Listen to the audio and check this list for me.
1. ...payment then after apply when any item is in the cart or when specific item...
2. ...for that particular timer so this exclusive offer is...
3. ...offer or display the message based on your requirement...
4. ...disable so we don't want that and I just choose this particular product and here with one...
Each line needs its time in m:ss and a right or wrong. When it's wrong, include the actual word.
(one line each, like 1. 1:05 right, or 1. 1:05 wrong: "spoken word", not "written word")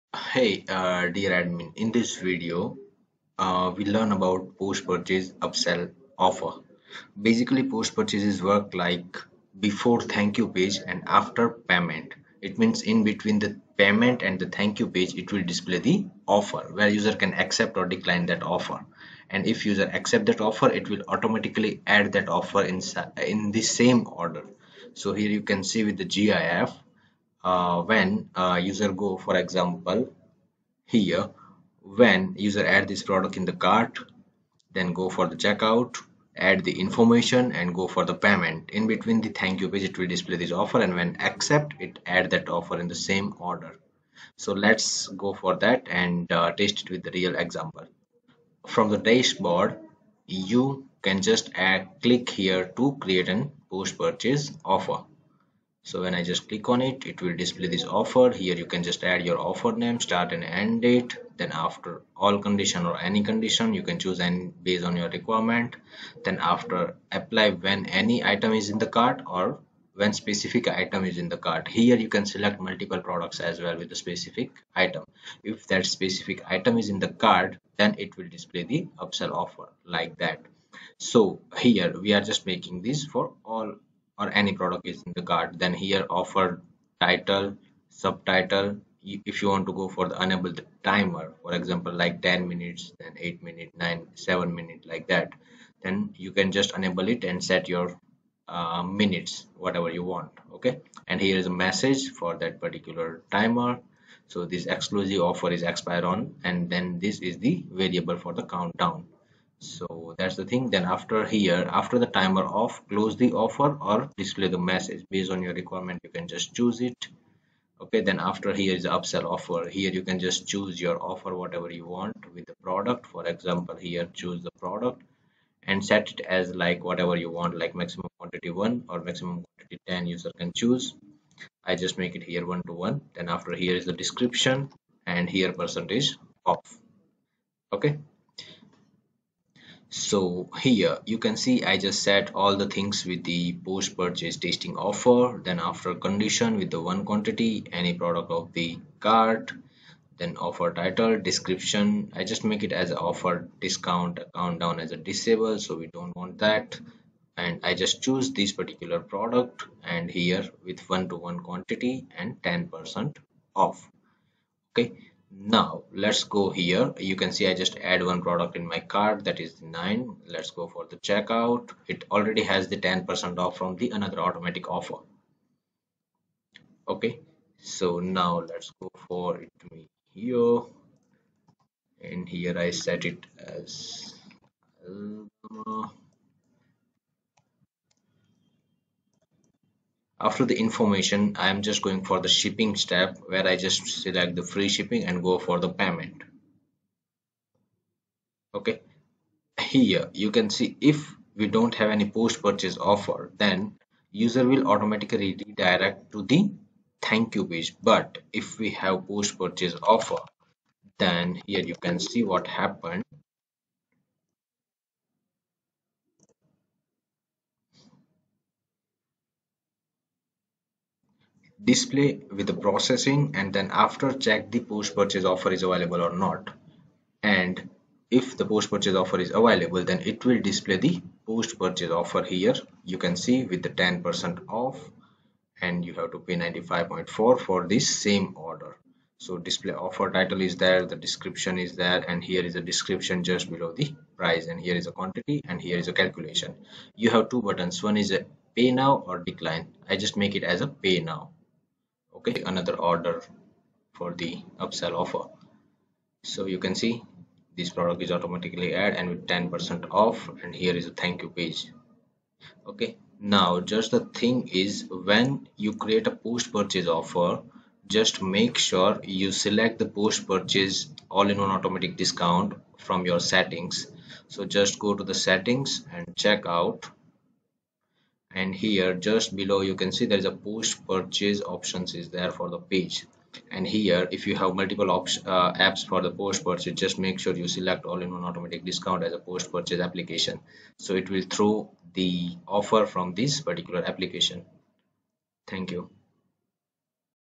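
1. 1:05 wrong: "requirement", not "payment"
2. 1:42 right
3. 1:53 right
4. 2:34 right.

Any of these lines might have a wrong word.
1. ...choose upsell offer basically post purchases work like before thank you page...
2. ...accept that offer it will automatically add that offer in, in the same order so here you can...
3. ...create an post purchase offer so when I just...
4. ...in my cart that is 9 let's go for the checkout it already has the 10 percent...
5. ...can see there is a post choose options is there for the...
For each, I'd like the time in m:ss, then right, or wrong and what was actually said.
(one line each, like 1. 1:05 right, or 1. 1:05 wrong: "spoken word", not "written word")
1. 0:04 wrong: "purchase", not "choose"
2. 0:20 right
3. 0:53 right
4. 2:48 right
5. 4:39 wrong: "purchase", not "choose".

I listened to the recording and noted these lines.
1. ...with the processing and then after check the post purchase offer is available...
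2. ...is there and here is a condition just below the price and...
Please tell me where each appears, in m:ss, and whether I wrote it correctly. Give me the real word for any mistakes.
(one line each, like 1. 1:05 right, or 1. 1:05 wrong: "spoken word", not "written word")
1. 3:42 right
2. 4:01 wrong: "description", not "condition".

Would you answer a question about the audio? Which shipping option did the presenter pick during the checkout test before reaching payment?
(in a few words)
Free shipping.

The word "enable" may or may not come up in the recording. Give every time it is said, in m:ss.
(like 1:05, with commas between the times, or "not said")
1:30, 1:36.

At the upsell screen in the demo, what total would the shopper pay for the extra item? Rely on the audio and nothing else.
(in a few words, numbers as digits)
95.4.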